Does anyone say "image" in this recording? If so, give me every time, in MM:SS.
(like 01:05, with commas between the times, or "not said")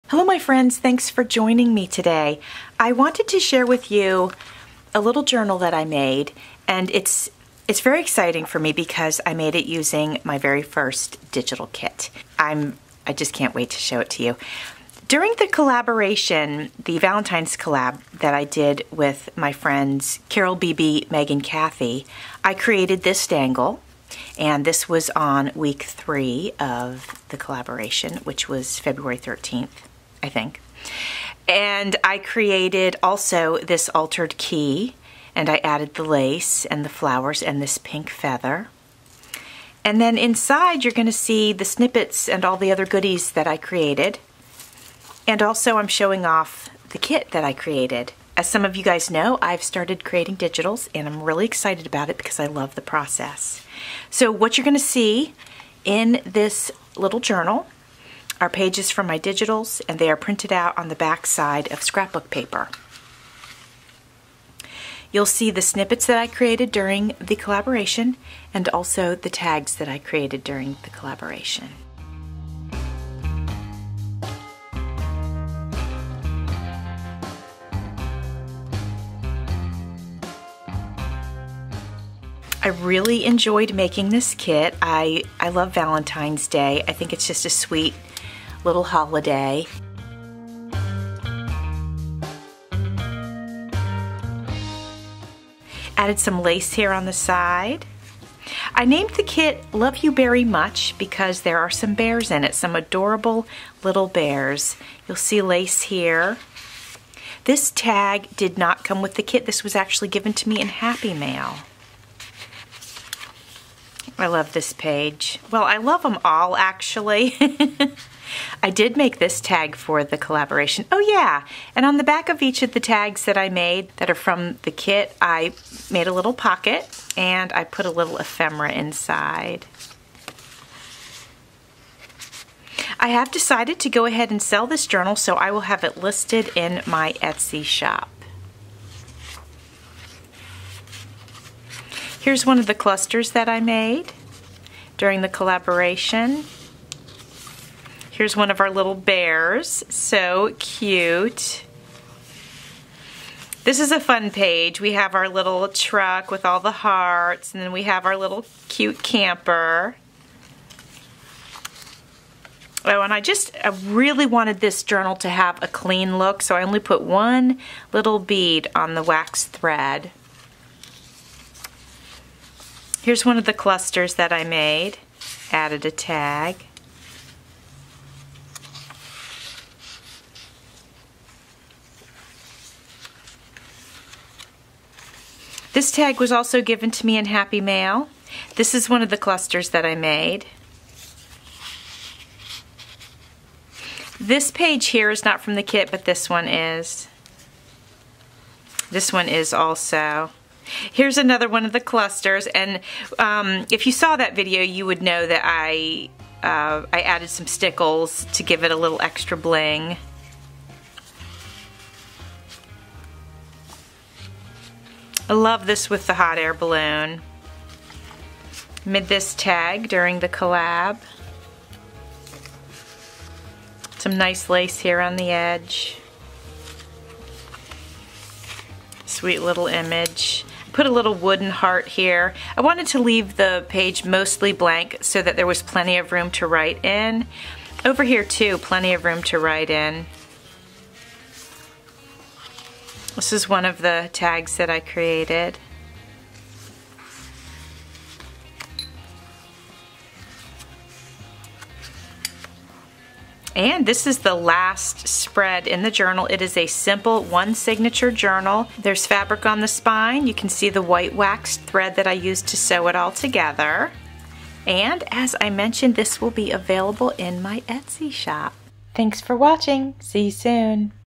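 03:49.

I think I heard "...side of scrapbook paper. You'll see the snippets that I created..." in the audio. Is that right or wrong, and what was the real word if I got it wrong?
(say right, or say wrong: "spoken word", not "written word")
right.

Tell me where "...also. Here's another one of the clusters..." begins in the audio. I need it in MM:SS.
03:19.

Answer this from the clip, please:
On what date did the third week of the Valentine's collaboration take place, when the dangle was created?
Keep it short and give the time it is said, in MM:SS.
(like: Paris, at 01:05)
February 13th, at 00:28.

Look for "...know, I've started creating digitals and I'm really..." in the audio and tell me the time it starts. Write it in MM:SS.
00:49.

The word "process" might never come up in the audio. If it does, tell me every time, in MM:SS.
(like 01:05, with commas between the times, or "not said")
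00:52.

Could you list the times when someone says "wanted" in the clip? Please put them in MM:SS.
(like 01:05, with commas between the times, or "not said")
00:02, 02:44, 03:52.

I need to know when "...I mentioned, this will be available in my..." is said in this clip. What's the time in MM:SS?
04:25.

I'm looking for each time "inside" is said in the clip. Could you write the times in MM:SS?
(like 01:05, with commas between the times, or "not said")
00:40, 02:08.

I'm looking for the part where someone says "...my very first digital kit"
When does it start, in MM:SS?
00:10.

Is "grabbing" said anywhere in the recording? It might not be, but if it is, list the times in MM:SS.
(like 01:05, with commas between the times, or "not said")
not said.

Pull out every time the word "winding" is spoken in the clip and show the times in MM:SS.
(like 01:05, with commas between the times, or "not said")
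not said.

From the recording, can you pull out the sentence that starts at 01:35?
Added some lace here on the side.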